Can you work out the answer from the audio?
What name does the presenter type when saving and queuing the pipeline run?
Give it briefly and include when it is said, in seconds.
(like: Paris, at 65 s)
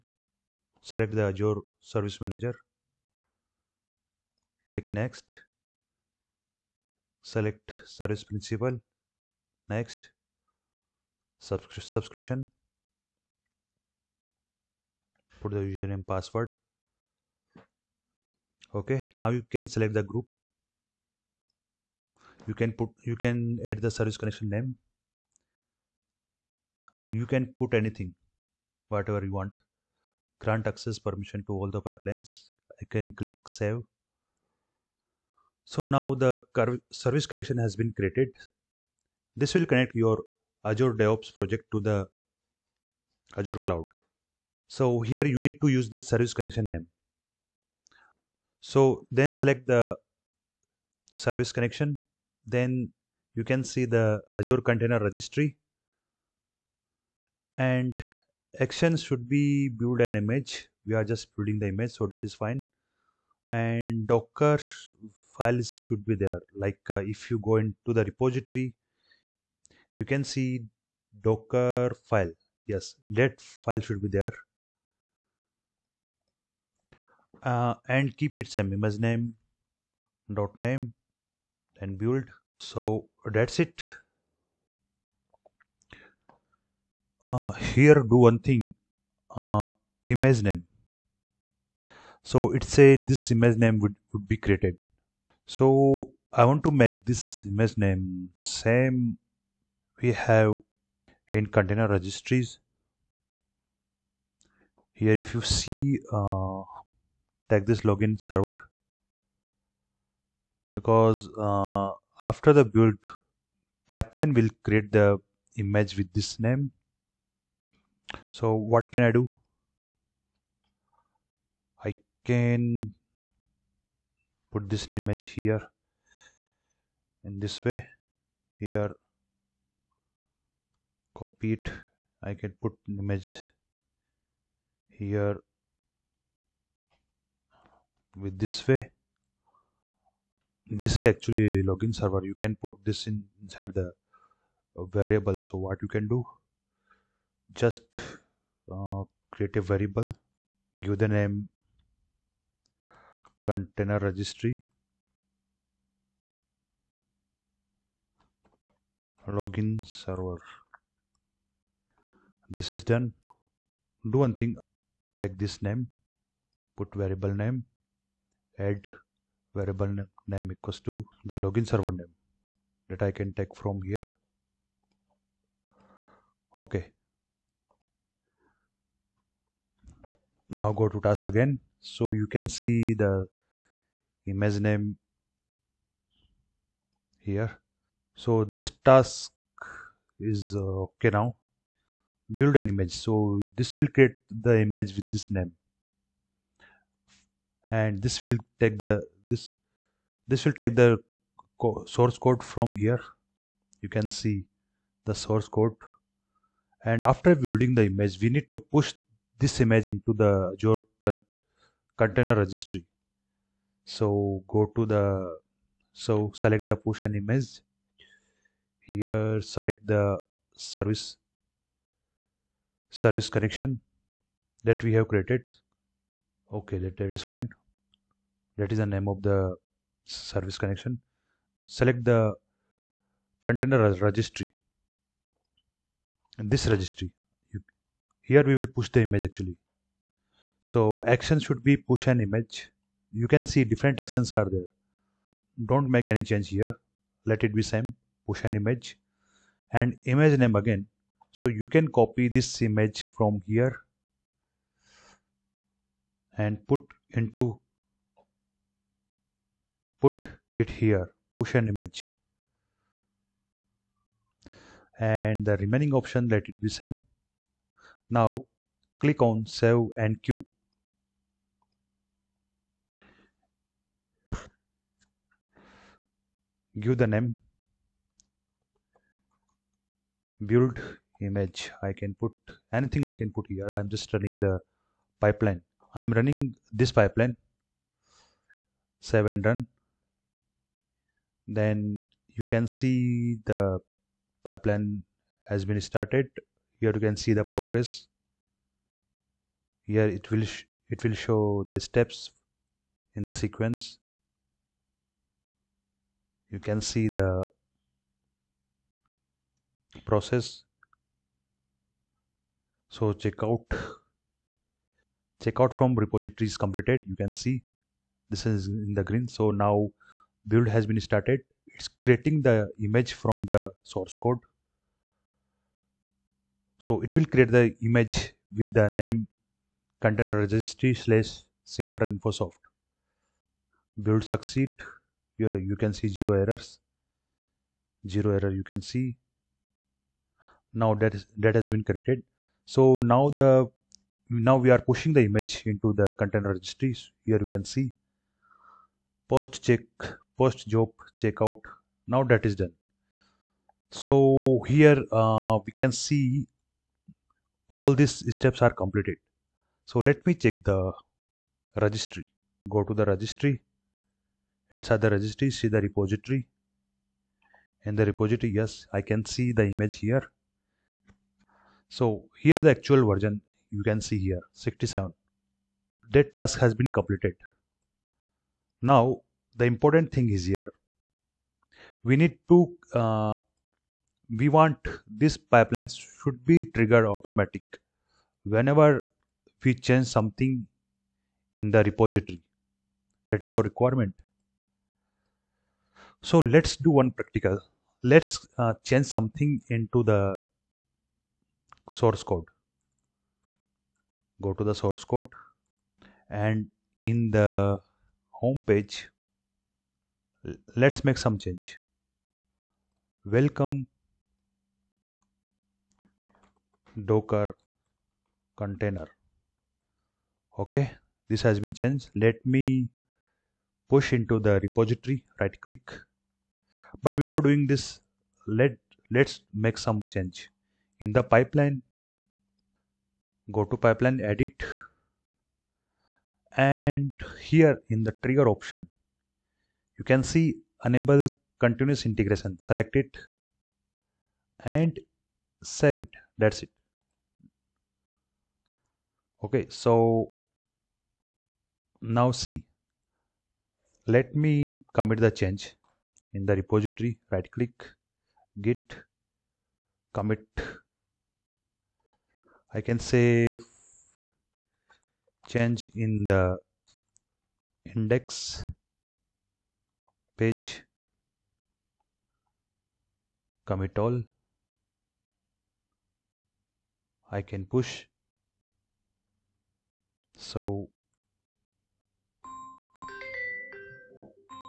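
Build image, at 280 s.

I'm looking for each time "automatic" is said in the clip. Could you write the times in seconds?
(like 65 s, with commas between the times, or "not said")
387 s.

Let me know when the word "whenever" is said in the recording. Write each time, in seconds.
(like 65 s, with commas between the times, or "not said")
388 s.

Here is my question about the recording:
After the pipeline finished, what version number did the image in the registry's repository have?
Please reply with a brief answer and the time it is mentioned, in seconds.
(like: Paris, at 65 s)
67, at 374 s.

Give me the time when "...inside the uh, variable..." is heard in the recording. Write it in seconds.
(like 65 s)
143 s.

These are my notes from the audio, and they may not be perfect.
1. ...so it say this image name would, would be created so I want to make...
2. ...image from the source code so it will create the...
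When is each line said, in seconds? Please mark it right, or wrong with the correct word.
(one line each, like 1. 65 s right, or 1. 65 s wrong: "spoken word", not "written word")
1. 92 s right
2. 322 s right.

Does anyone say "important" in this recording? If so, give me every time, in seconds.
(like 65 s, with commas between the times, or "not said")
379 s.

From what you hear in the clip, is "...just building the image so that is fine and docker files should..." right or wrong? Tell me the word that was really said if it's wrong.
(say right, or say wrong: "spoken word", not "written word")
right.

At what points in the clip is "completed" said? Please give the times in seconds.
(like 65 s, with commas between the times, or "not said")
316 s, 358 s, 376 s.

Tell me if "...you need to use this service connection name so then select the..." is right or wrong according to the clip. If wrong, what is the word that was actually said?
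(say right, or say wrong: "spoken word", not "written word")
right.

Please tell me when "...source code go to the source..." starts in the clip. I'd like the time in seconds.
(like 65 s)
401 s.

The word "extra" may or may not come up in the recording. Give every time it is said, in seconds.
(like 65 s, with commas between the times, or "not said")
not said.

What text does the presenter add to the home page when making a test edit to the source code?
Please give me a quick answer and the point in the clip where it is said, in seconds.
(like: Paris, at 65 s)
Welcome docker container, at 413 s.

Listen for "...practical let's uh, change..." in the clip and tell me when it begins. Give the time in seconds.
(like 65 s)
397 s.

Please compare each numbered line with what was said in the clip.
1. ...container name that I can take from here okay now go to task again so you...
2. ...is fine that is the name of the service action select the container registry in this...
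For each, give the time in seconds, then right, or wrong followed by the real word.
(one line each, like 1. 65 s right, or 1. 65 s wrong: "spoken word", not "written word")
1. 171 s wrong: "server", not "container"
2. 227 s wrong: "connection", not "action".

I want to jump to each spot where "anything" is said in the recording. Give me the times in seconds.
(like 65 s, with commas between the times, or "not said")
27 s, 282 s.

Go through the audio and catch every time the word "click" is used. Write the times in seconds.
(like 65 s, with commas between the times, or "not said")
4 s, 33 s, 269 s, 425 s, 457 s.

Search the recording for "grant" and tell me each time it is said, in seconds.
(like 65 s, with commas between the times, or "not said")
30 s.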